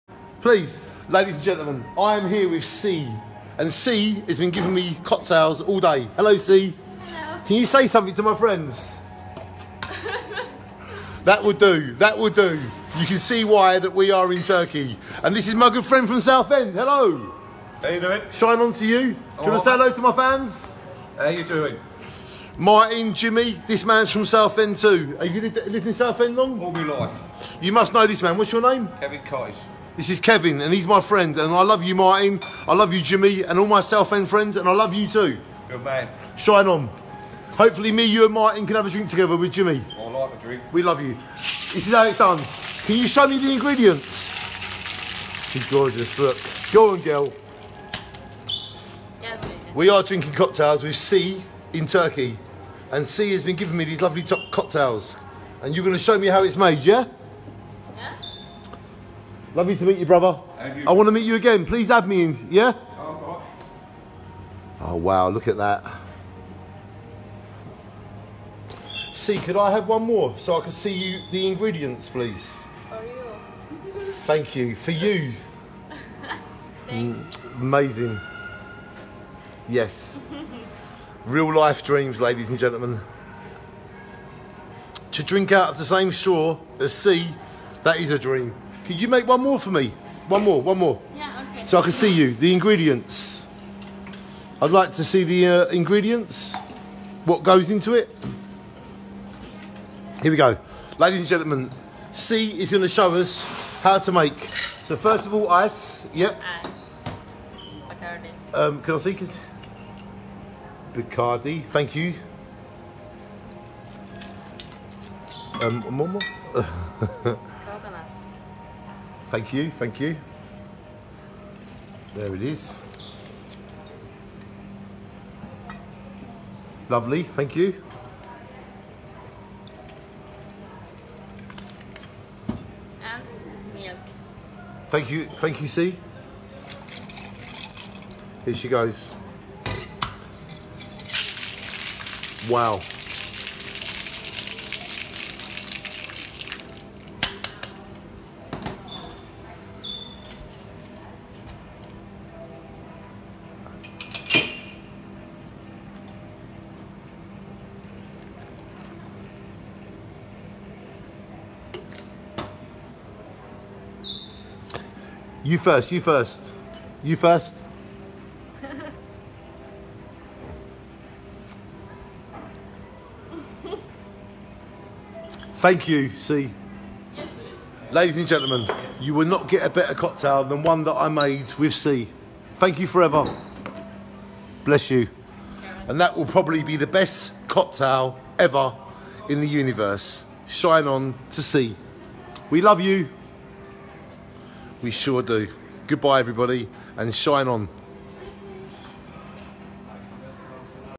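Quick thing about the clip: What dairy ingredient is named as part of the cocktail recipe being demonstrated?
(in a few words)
Milk.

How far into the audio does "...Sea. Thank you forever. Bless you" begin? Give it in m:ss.
3:01.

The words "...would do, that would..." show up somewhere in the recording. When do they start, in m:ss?
0:11.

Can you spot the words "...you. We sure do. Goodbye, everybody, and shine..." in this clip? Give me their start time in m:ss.
3:12.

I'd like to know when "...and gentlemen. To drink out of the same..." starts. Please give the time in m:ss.
1:22.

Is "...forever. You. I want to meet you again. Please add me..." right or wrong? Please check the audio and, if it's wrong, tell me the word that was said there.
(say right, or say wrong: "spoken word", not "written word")
wrong: "brother", not "forever".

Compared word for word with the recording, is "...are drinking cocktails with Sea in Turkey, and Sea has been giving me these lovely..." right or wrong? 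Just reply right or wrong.
right.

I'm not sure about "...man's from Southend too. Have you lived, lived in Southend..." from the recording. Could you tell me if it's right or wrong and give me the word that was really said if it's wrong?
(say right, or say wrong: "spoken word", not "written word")
right.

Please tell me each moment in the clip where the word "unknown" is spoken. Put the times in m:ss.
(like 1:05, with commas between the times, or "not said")
not said.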